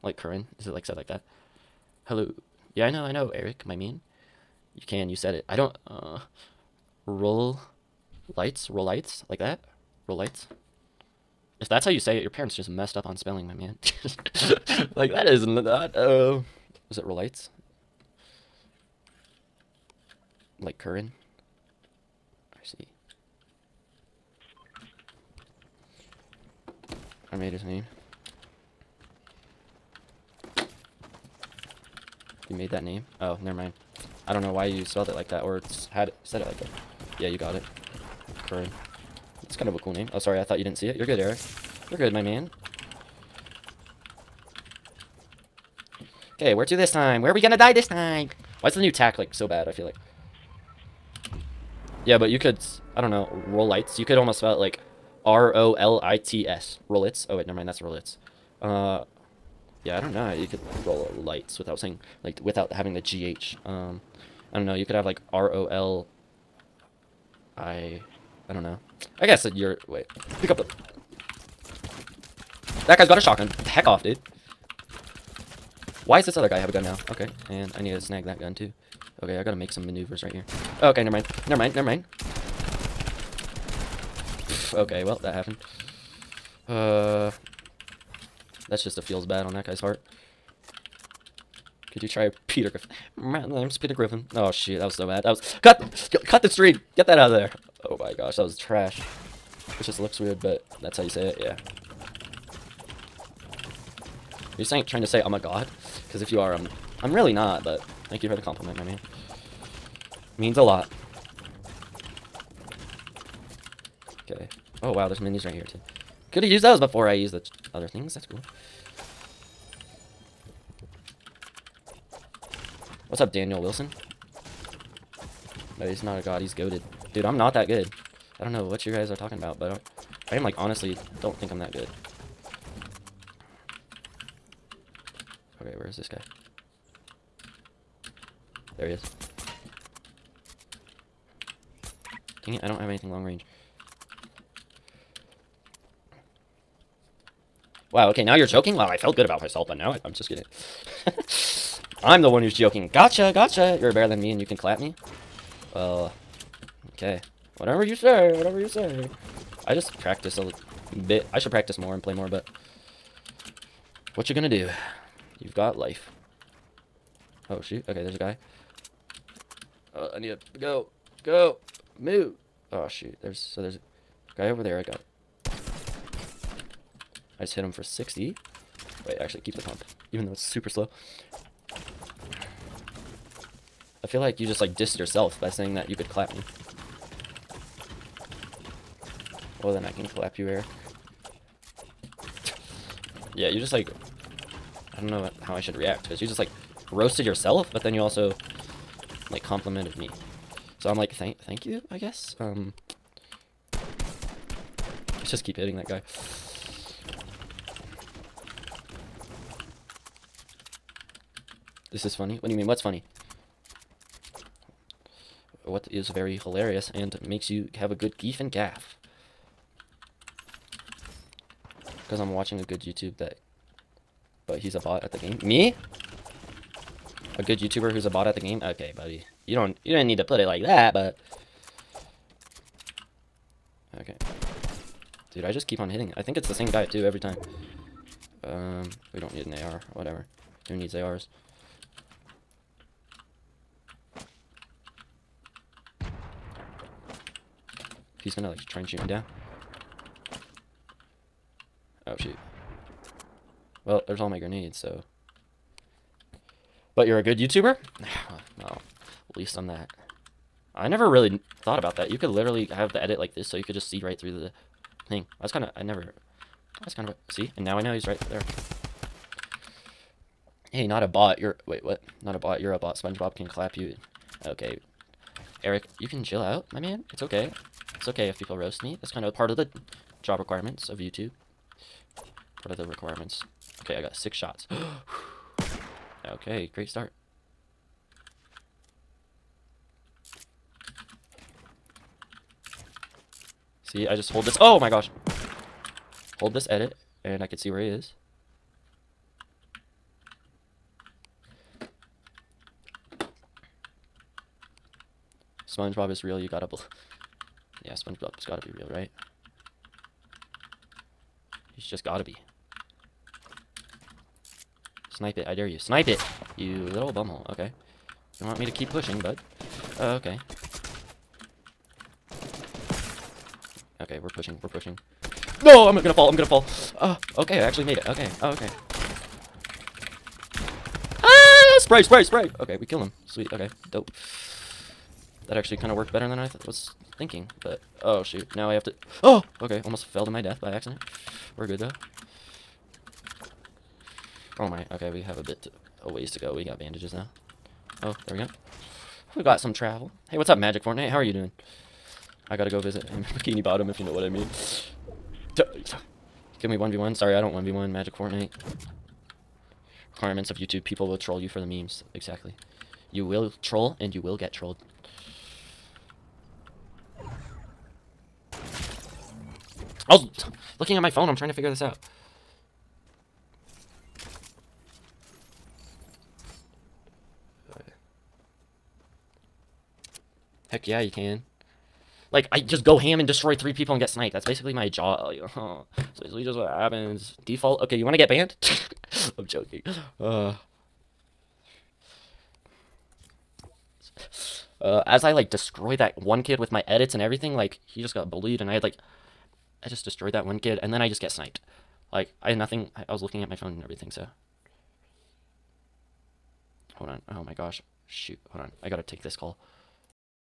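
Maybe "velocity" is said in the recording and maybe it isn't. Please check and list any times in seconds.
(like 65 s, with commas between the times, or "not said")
not said.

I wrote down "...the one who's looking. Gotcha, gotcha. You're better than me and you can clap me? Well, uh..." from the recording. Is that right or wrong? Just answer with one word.
wrong.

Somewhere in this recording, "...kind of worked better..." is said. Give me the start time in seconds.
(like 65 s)
335 s.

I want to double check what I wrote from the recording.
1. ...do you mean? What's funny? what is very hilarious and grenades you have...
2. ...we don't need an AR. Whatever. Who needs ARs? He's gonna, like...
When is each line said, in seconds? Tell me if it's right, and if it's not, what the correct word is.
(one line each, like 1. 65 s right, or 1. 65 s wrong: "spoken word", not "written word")
1. 212 s wrong: "makes", not "grenades"
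2. 239 s right.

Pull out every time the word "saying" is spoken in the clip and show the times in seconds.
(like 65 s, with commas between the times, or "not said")
61 s, 104 s, 185 s.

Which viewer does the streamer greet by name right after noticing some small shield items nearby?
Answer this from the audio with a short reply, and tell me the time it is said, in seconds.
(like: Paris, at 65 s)
Daniel Wilson, at 123 s.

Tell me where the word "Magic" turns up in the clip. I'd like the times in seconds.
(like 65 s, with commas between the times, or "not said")
350 s, 357 s.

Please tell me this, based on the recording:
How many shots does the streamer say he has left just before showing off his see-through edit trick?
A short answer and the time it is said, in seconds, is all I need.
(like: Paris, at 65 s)
6, at 284 s.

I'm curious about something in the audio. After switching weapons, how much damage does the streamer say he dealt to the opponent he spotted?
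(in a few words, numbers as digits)
60.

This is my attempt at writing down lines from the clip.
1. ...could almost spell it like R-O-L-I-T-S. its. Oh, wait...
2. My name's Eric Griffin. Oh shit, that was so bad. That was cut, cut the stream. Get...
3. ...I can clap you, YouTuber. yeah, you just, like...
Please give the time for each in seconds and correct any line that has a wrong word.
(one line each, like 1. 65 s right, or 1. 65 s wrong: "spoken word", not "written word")
1. 54 s right
2. 93 s wrong: "Peter", not "Eric"
3. 189 s wrong: "Eric", not "YouTuber".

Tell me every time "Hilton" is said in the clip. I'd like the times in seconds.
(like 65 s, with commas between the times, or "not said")
not said.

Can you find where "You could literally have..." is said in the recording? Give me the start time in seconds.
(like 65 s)
262 s.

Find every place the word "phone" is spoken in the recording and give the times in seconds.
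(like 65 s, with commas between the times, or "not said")
371 s, 403 s.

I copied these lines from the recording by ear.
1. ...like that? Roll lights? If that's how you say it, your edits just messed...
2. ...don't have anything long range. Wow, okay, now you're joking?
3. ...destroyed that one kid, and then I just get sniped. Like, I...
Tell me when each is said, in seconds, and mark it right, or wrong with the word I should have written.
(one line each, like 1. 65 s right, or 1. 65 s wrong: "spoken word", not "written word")
1. 9 s wrong: "parents", not "edits"
2. 142 s right
3. 400 s right.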